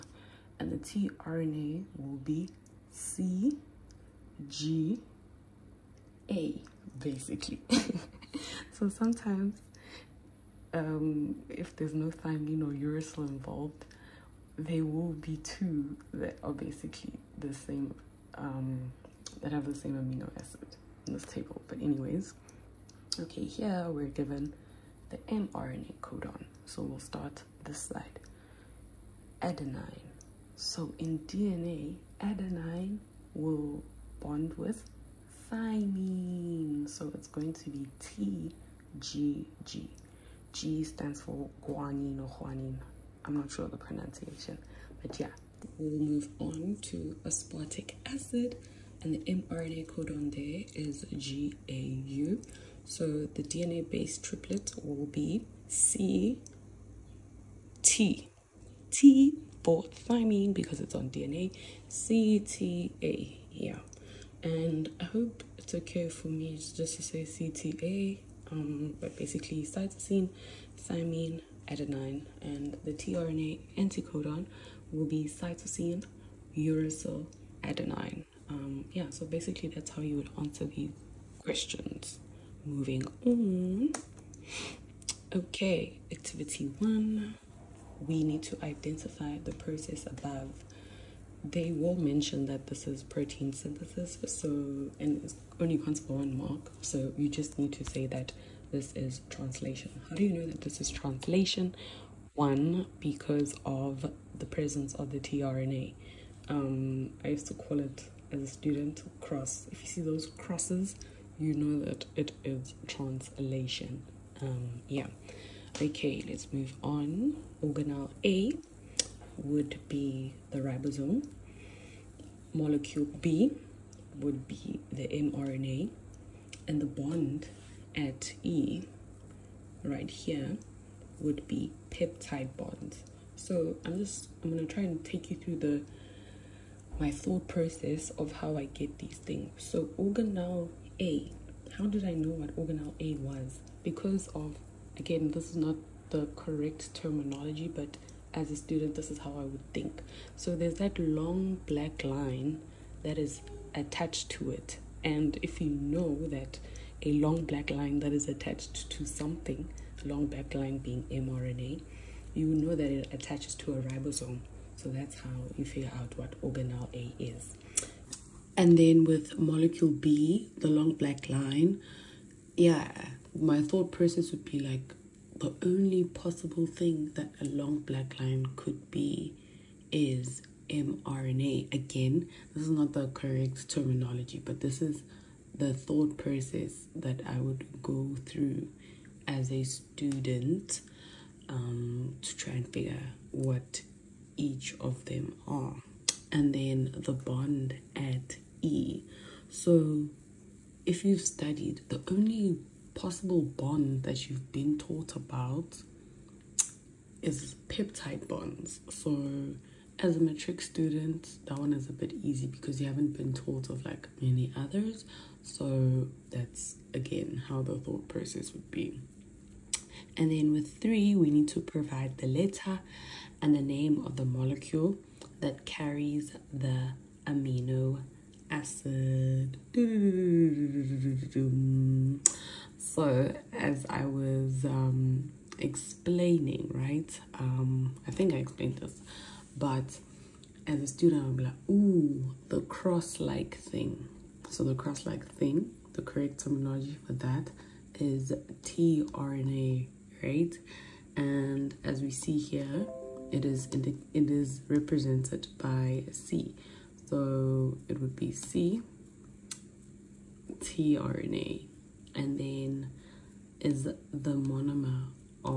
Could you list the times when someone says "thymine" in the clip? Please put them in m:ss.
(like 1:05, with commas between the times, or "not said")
0:12, 0:35, 0:59, 1:10.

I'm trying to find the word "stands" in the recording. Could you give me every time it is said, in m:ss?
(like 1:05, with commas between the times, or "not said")
0:40.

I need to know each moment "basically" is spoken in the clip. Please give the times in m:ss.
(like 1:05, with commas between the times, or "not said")
0:06, 0:16, 1:09, 1:19.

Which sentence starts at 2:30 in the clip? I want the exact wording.
So there's that long black line that is attached to it.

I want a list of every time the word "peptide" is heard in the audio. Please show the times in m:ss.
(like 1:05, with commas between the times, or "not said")
2:11, 3:27.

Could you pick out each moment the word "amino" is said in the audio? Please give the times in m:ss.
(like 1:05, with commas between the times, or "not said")
0:19, 3:47.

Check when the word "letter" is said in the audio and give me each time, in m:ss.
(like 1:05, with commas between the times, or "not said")
3:42.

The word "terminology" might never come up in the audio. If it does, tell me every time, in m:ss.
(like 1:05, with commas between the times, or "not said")
2:26, 3:03, 4:06.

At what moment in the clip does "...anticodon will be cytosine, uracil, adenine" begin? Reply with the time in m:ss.
1:13.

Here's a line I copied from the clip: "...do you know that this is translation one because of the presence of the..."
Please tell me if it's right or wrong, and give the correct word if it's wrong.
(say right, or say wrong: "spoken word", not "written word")
right.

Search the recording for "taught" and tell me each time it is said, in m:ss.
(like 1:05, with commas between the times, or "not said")
3:24, 3:33.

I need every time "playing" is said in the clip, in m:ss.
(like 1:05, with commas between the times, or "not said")
not said.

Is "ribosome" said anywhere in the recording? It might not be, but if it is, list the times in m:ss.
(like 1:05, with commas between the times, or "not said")
2:00, 2:43.